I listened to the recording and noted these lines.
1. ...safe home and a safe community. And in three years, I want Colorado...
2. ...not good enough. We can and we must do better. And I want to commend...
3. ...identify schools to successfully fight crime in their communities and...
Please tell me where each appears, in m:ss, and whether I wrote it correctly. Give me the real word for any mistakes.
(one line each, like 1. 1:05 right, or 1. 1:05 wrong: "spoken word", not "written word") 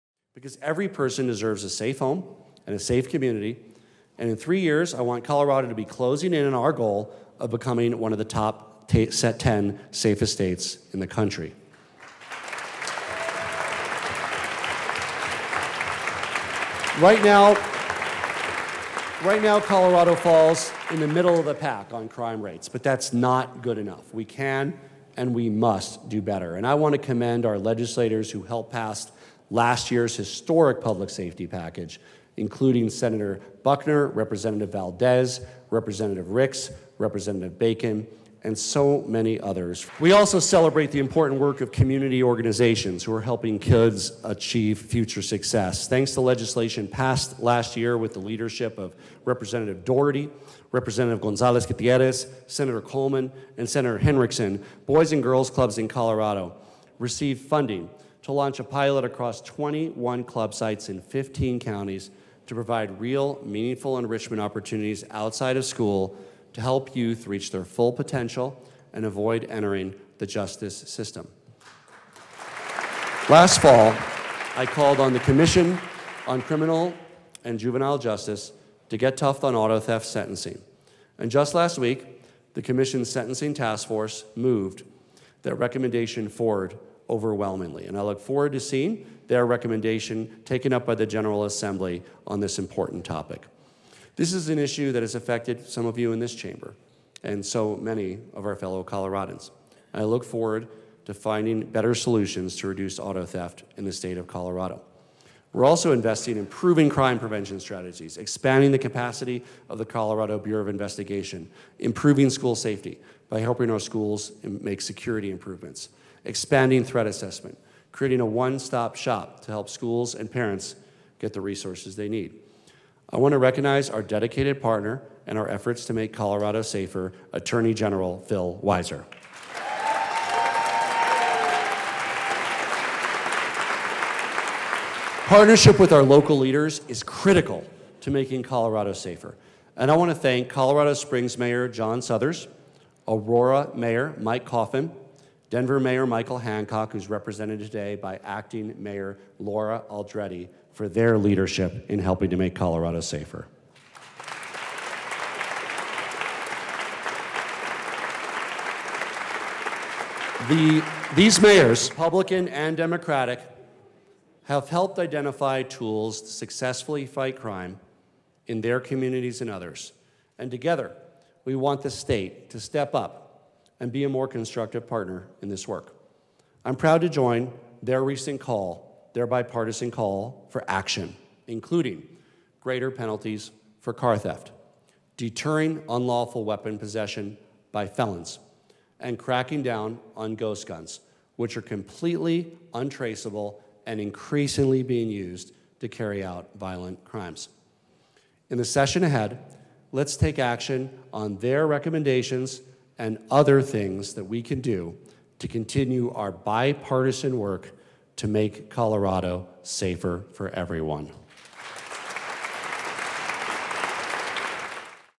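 1. 0:01 right
2. 0:23 right
3. 2:44 wrong: "tools", not "schools".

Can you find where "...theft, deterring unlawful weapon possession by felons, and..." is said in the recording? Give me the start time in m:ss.
3:04.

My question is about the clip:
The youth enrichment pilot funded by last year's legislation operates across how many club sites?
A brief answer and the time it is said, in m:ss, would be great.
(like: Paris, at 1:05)
21, at 0:59.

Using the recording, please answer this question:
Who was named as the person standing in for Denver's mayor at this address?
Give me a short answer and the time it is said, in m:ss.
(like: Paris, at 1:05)
Laura Aldrete, at 2:29.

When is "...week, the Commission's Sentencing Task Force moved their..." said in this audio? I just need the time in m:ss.
1:21.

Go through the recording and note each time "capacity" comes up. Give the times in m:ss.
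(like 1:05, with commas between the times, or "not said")
1:48.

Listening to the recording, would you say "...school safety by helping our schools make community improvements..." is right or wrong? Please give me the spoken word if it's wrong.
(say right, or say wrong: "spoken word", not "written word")
wrong: "security", not "community".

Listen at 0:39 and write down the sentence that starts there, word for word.
We also celebrate the important work of community organizations who are helping kids achieve future success.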